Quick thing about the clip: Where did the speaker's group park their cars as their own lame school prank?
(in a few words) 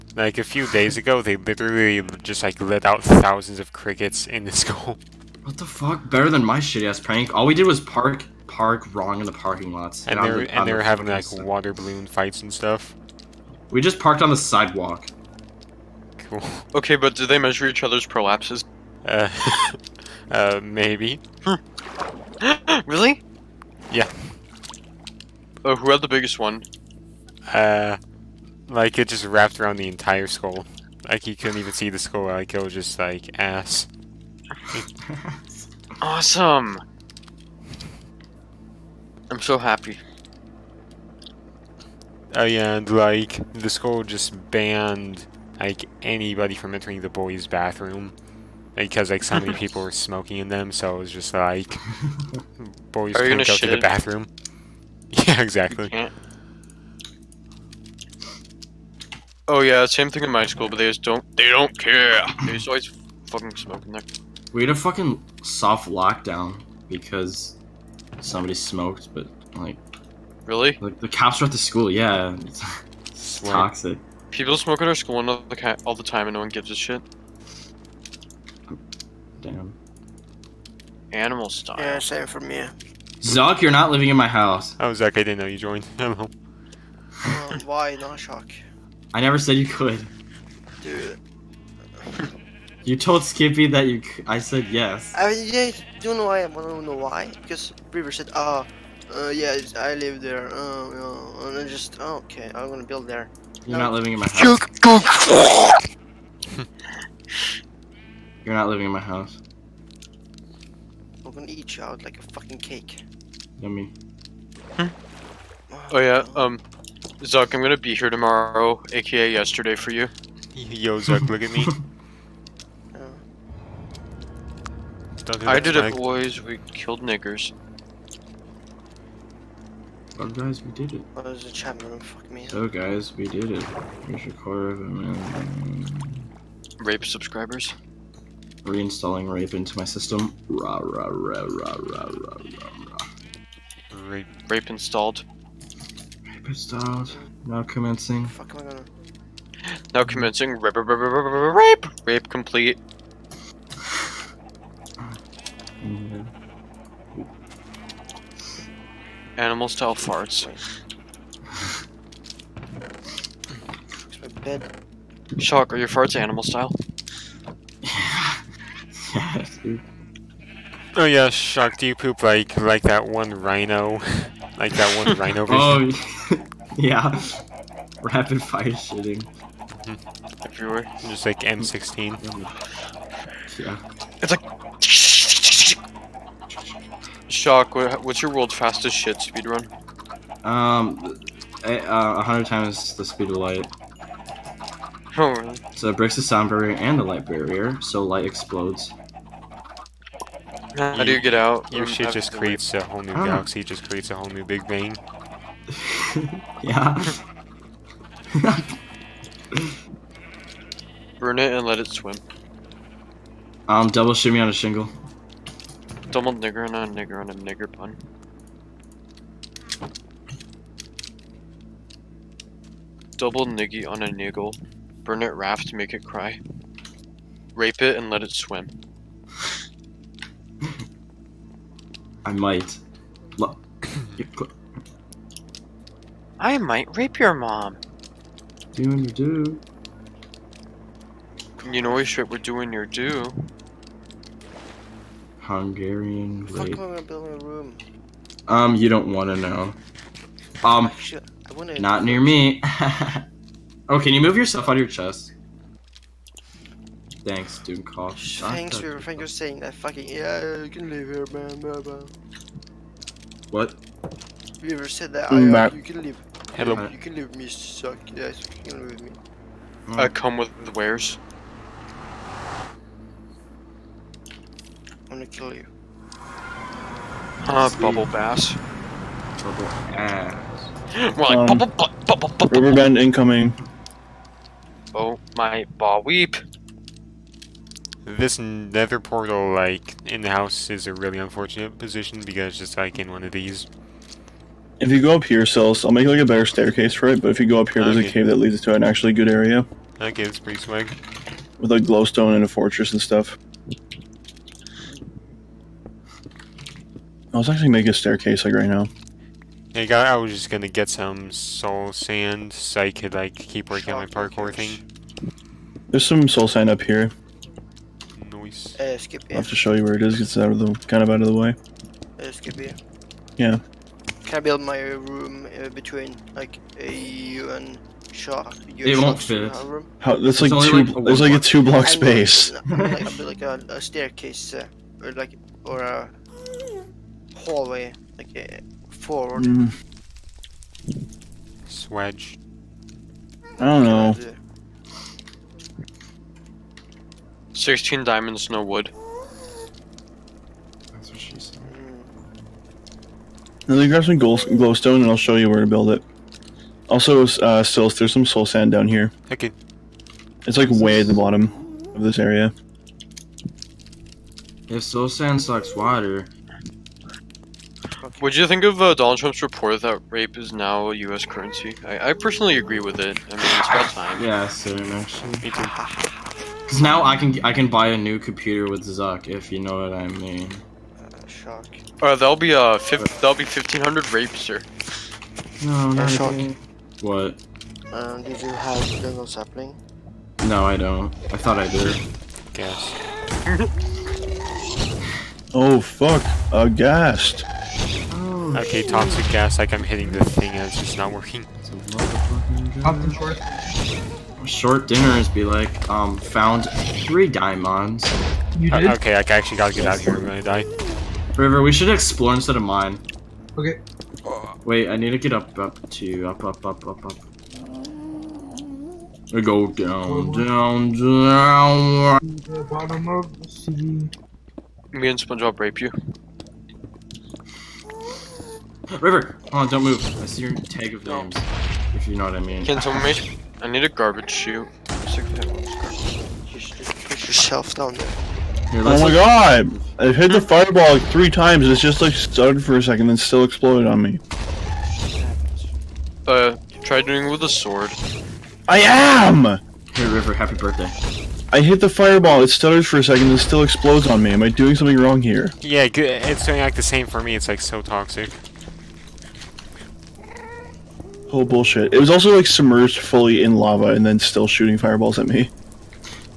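on the sidewalk.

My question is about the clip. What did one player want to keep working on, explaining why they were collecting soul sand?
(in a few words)
parkour thing.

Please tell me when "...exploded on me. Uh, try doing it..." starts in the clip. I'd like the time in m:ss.
7:23.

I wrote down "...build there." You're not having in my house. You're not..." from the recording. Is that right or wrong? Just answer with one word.
wrong.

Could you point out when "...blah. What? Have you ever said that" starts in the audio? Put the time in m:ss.
4:21.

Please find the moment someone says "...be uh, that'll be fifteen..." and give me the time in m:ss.
6:22.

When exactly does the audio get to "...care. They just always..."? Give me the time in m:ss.
1:01.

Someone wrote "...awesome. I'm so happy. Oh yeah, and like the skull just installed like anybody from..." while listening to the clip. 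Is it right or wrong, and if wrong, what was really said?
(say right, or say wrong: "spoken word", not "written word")
wrong: "banned", not "installed".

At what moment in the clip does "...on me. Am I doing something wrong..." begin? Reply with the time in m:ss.
7:34.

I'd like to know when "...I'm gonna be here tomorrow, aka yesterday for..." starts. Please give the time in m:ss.
1:57.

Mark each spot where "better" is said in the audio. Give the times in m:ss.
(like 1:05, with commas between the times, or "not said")
0:06, 4:56.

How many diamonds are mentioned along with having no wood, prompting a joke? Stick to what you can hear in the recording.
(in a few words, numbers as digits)
16.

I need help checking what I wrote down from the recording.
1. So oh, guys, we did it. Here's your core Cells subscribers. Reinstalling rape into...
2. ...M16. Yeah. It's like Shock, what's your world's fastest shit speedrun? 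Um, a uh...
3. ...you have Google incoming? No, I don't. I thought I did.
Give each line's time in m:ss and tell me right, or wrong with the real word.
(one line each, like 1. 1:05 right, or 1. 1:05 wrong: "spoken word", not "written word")
1. 2:12 wrong: "Rape", not "Cells"
2. 3:01 right
3. 6:28 wrong: "sapling", not "incoming".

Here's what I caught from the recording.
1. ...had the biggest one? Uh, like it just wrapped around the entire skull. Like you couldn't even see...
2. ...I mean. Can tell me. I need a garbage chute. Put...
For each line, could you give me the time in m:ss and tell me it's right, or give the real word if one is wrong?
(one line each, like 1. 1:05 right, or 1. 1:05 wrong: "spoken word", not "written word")
1. 0:25 right
2. 7:12 right.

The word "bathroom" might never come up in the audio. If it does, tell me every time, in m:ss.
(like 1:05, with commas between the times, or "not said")
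0:47, 0:53.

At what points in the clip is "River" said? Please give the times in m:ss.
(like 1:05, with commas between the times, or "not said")
1:37, 6:51, 7:08, 7:30.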